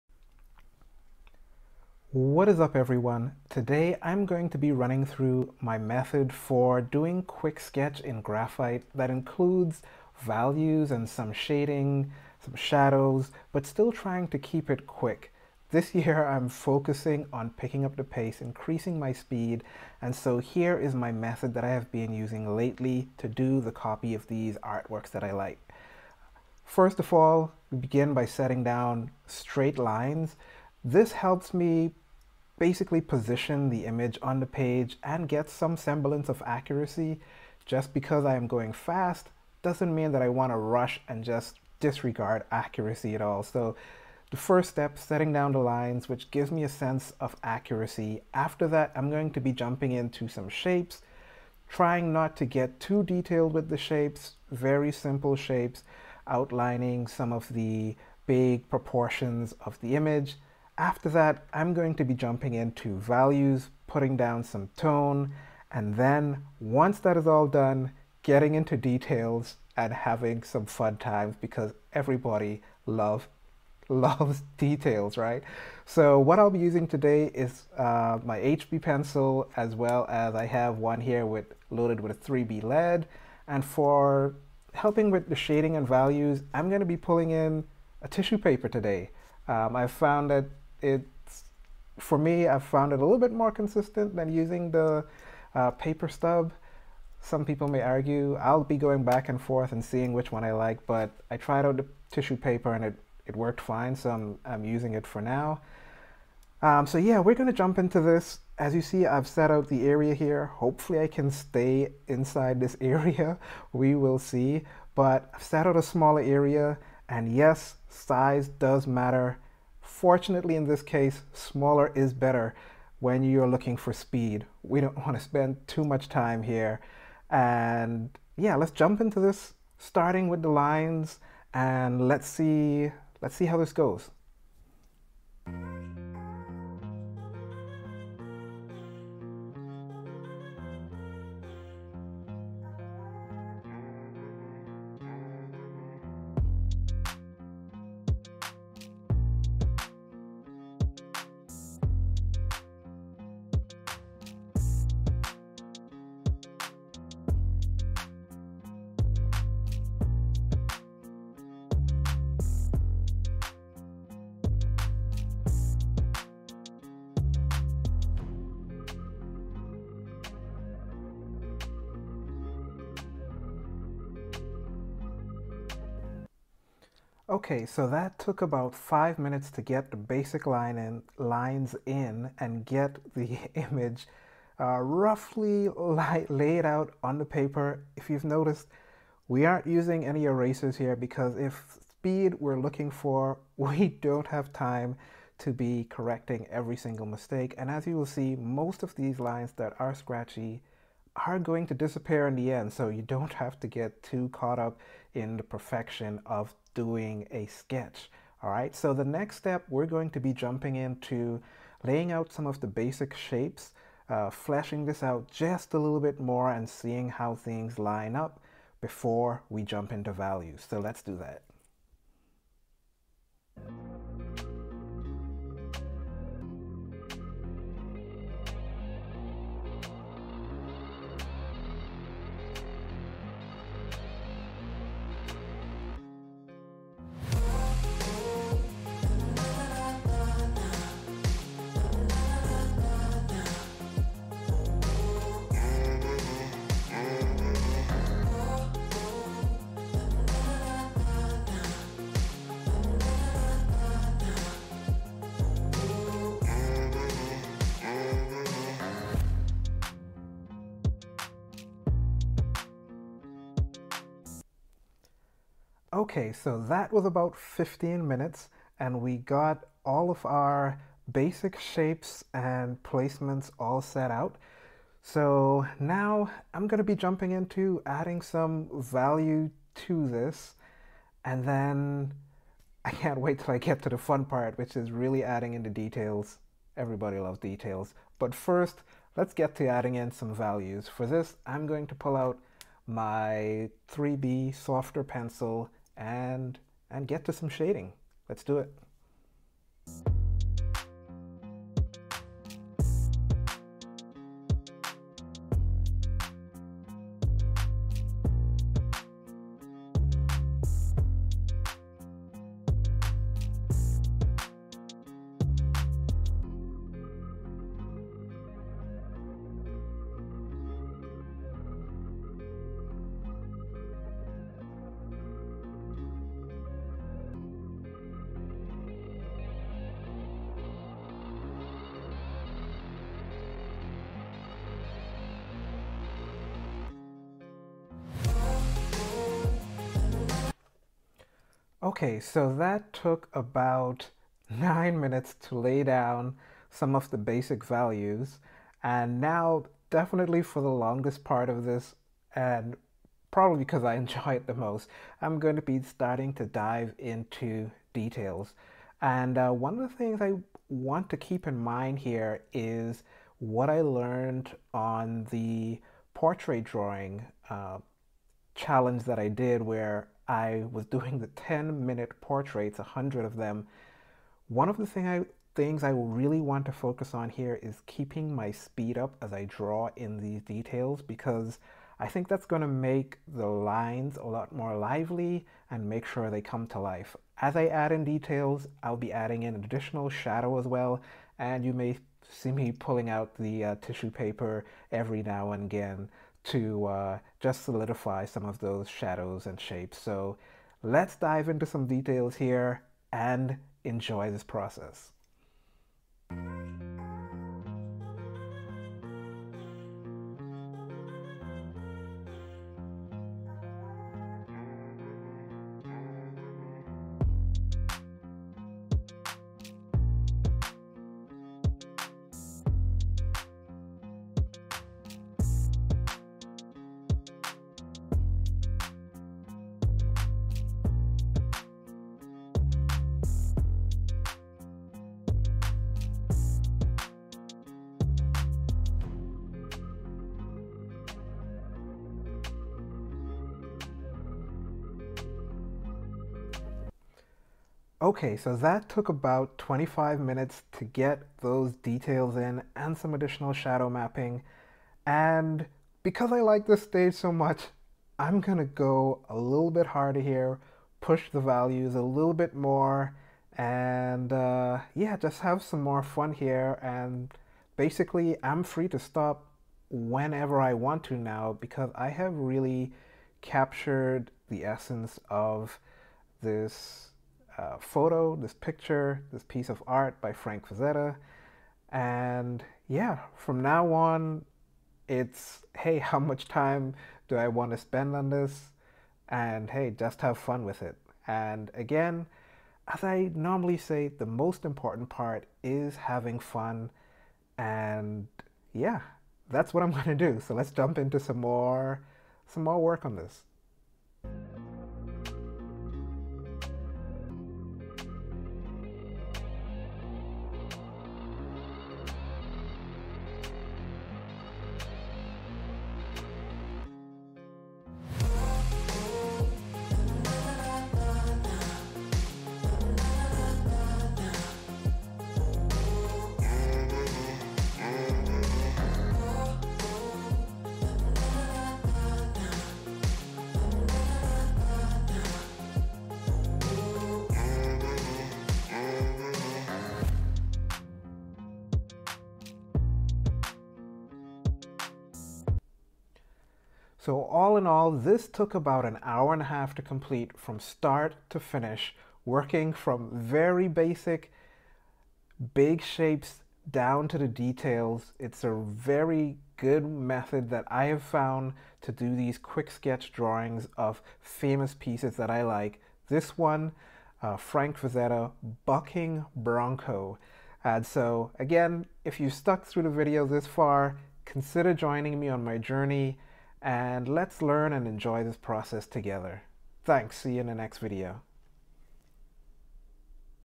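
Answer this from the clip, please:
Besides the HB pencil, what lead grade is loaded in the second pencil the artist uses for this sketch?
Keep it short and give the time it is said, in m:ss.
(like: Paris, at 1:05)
3B, at 1:22.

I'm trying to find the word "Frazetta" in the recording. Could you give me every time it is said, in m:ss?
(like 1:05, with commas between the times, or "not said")
8:00, 9:27.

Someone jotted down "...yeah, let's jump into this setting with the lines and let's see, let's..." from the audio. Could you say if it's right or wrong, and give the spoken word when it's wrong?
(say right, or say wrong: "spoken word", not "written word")
wrong: "starting", not "setting".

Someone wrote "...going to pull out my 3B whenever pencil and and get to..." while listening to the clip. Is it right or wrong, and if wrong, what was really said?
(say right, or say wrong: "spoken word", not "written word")
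wrong: "softer", not "whenever".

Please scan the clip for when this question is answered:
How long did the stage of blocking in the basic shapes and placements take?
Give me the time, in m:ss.
4:27.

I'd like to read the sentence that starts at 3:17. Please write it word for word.
And as you will see, most of these lines that are scratchy are going to disappear in the end.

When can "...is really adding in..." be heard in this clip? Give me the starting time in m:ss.
4:44.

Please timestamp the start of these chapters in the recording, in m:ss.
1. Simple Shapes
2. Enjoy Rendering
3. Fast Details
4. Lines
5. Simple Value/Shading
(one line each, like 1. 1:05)
1. 2:58
2. 7:27
3. 5:42
4. 2:15
5. 4:25.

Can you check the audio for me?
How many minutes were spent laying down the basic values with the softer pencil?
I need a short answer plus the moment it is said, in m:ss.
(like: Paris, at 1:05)
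9, at 5:44.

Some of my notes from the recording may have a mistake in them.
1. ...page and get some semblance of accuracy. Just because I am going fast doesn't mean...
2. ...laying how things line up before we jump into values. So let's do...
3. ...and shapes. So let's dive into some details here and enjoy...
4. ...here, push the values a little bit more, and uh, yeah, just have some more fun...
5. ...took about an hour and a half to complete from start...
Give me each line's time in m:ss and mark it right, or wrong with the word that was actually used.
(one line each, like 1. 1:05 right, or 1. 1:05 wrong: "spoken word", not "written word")
1. 0:34 right
2. 3:36 wrong: "seeing", not "laying"
3. 6:39 right
4. 7:40 right
5. 9:08 right.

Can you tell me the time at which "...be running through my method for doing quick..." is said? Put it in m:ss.
0:04.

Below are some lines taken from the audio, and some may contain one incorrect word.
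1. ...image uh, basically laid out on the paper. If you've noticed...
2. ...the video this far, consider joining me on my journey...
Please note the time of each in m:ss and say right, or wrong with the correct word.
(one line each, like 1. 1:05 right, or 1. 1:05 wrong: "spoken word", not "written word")
1. 3:03 wrong: "roughly", not "basically"
2. 9:32 right.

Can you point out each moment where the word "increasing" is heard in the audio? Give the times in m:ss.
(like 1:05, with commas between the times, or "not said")
0:18.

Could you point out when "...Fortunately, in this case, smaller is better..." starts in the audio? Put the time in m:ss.
1:59.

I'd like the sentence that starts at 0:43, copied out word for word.
So the first step, setting down the lines, which gives me a sense of accuracy.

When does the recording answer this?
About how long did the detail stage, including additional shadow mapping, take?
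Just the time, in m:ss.
7:29.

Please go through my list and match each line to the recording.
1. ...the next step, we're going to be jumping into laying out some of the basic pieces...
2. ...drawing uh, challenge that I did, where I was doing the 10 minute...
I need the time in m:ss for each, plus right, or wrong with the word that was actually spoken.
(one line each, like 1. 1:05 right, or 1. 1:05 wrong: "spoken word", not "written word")
1. 3:28 wrong: "shapes", not "pieces"
2. 6:06 right.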